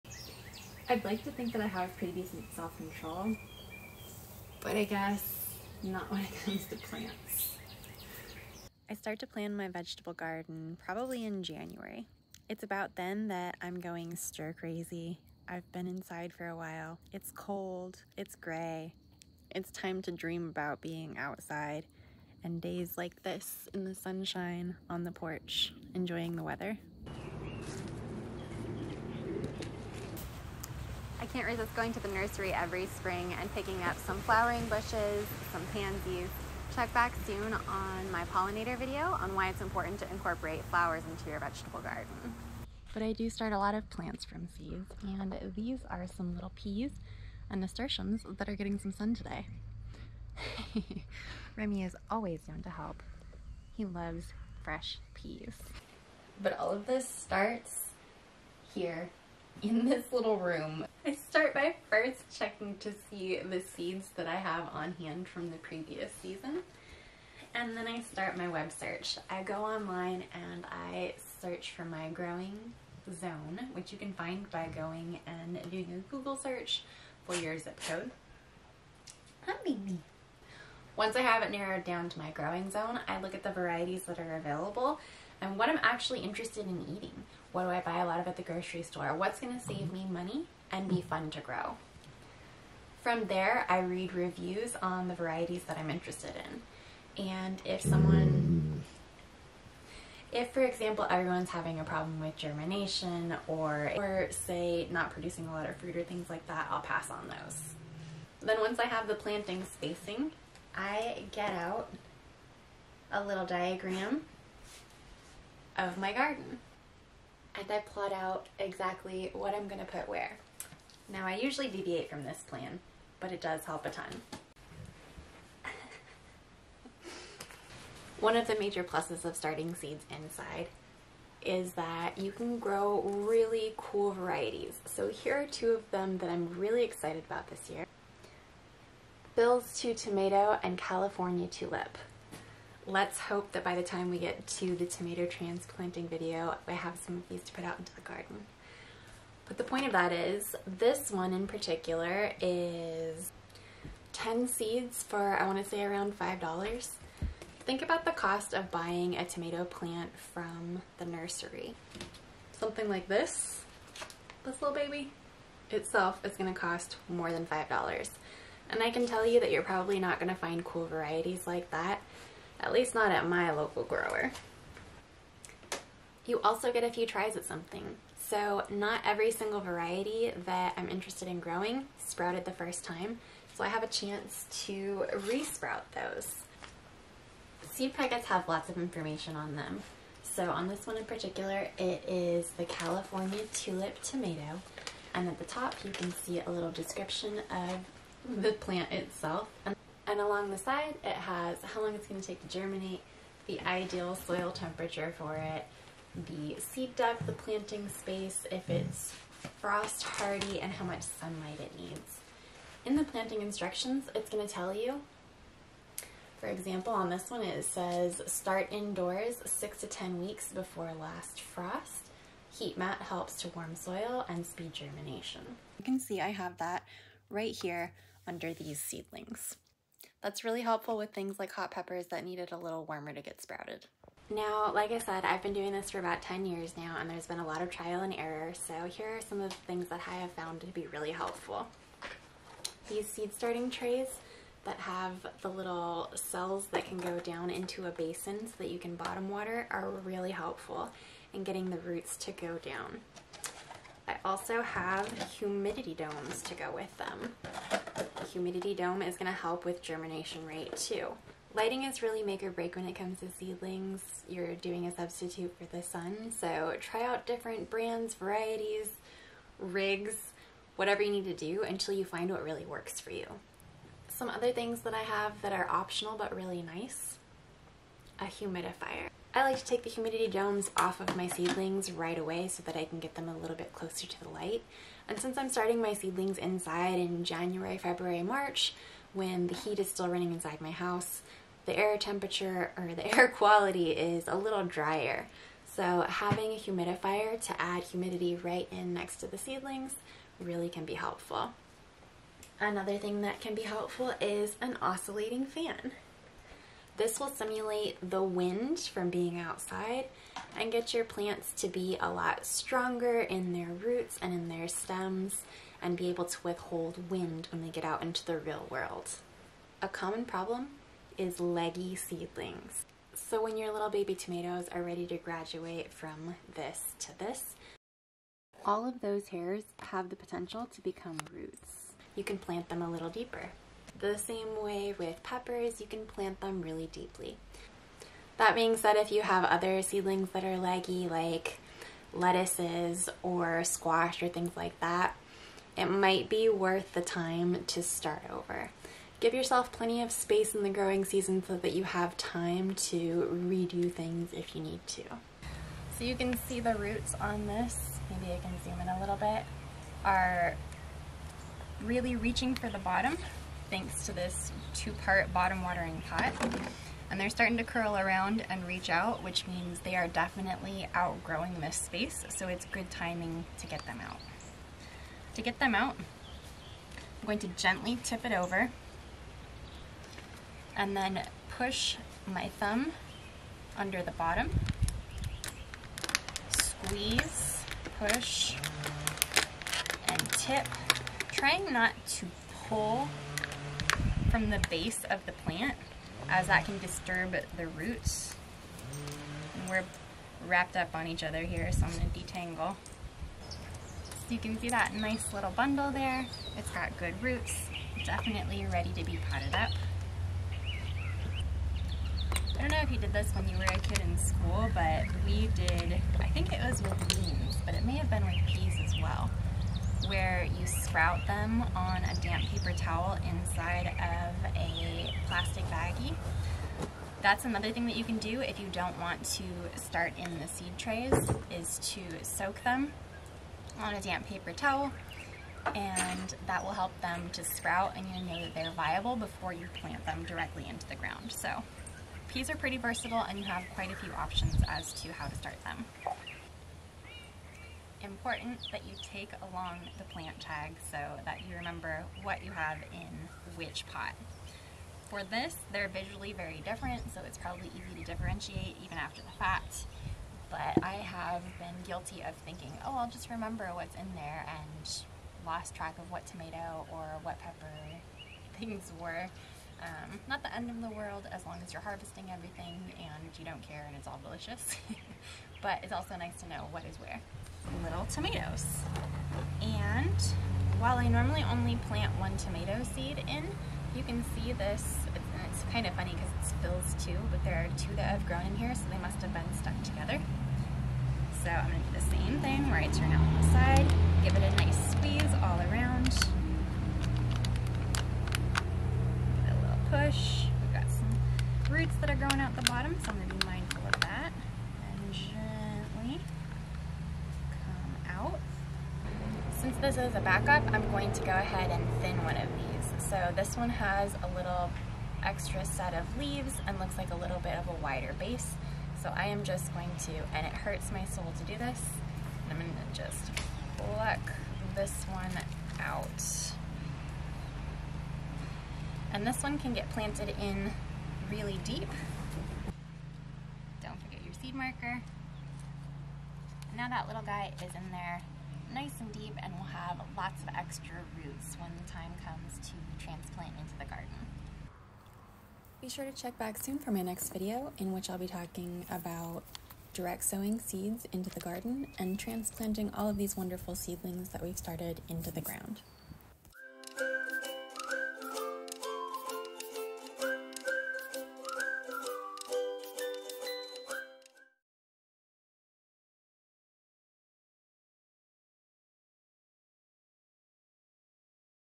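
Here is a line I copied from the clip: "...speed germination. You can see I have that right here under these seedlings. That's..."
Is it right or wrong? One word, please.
right.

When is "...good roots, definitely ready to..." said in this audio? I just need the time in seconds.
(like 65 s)
406 s.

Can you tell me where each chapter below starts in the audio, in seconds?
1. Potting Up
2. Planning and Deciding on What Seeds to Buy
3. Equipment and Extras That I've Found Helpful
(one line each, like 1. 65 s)
1. 355 s
2. 55 s
3. 233 s.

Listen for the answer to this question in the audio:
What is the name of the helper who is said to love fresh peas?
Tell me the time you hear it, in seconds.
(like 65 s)
51 s.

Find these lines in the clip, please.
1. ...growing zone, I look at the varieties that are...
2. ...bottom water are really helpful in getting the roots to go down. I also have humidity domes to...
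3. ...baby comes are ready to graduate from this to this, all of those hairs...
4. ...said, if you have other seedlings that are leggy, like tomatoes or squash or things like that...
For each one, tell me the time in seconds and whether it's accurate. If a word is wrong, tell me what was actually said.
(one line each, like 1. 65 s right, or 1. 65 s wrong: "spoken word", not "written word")
1. 82 s right
2. 248 s right
3. 323 s wrong: "tomatoes", not "comes"
4. 338 s wrong: "lettuces", not "tomatoes".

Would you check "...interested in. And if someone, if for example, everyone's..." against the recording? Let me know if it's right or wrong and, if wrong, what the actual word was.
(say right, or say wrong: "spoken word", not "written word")
right.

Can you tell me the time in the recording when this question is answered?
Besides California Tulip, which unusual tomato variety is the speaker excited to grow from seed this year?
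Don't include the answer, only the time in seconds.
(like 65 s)
139 s.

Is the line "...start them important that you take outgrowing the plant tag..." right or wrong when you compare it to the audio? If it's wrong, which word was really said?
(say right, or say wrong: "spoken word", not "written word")
wrong: "along", not "outgrowing".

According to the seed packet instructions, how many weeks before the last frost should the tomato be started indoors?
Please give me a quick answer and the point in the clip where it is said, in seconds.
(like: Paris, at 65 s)
6 to 10 weeks, at 219 s.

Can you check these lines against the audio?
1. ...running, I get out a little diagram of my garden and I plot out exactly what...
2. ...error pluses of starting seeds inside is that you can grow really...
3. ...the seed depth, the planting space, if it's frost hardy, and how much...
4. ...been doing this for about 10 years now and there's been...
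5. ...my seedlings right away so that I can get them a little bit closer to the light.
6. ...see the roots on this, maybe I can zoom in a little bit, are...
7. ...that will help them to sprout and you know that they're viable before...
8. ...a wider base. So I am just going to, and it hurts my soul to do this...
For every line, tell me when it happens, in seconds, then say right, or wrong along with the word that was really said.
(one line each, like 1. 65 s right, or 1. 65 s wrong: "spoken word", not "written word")
1. 109 s wrong: "spacing", not "running"
2. 128 s wrong: "major", not "error"
3. 206 s right
4. 235 s right
5. 281 s right
6. 356 s right
7. 436 s right
8. 517 s right.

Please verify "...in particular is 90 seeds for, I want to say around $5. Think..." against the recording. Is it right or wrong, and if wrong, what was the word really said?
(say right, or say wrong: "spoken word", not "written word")
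wrong: "10", not "90".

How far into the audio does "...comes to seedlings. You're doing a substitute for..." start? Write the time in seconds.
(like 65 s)
262 s.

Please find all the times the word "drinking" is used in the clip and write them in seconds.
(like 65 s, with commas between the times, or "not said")
not said.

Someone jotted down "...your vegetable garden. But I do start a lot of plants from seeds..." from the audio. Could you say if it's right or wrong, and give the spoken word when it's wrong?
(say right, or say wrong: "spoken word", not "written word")
right.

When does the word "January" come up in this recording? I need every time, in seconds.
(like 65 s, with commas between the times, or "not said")
11 s, 287 s.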